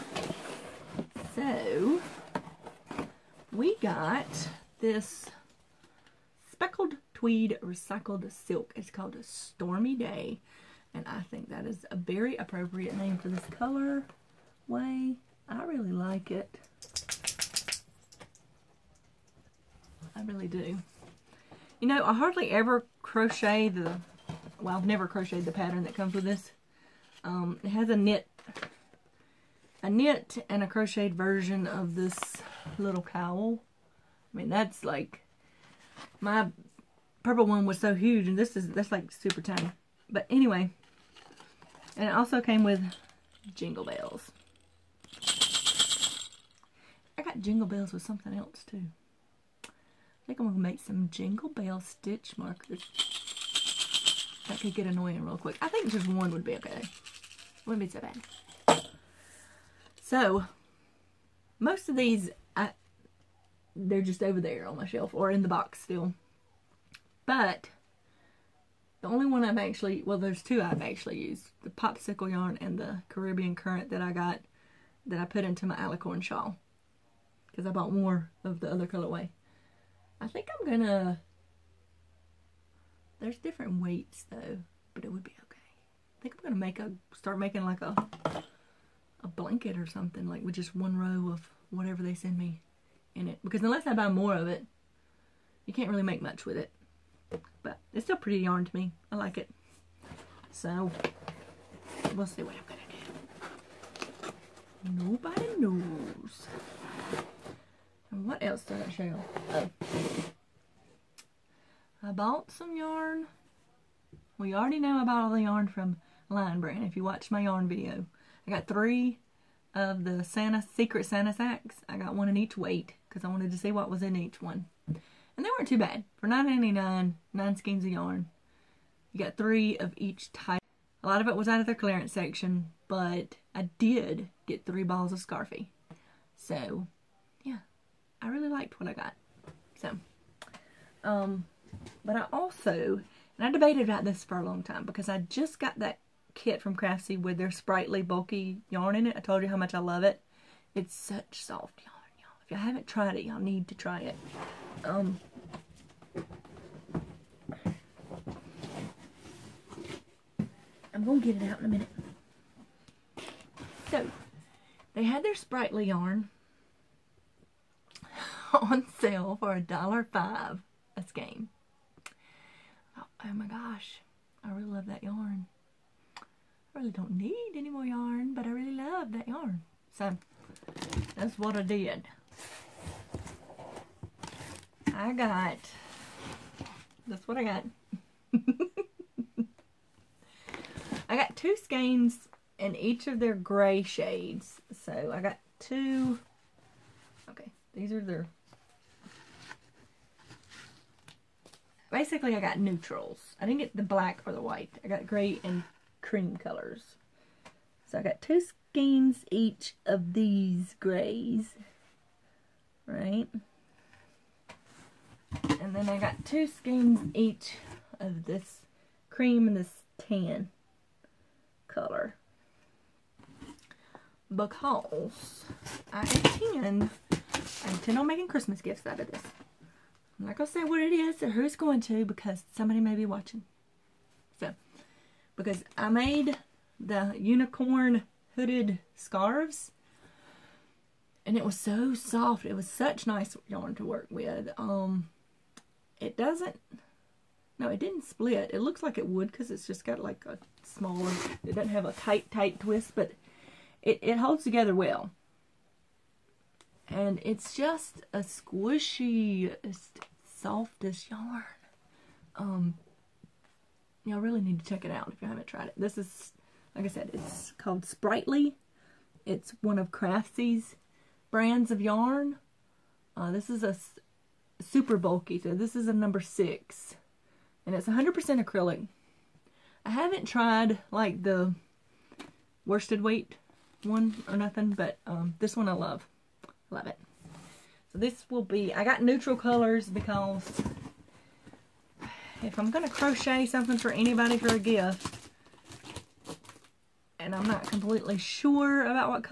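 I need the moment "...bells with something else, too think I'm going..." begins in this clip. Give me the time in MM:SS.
00:47.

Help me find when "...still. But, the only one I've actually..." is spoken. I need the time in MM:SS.
01:05.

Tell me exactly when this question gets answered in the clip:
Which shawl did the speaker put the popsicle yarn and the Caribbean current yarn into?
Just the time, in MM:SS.
01:15.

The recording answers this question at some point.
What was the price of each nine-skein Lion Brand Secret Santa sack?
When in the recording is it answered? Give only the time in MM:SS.
02:06.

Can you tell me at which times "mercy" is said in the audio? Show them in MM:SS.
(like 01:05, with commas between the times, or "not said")
not said.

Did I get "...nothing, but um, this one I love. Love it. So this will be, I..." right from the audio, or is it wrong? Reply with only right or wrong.
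right.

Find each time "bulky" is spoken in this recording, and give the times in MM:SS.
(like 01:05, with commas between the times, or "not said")
02:28, 04:34.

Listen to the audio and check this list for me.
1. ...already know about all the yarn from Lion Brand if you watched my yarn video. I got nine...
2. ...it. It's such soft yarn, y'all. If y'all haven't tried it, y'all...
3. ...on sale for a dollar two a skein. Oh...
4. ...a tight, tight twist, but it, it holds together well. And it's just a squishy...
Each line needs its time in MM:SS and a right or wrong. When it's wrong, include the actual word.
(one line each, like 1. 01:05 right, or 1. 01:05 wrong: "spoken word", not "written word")
1. 01:54 wrong: "three", not "nine"
2. 02:30 right
3. 02:48 wrong: "five", not "two"
4. 04:11 right.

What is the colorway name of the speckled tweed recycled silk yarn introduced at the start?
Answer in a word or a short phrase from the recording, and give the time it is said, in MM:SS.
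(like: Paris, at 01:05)
Stormy Day, at 00:09.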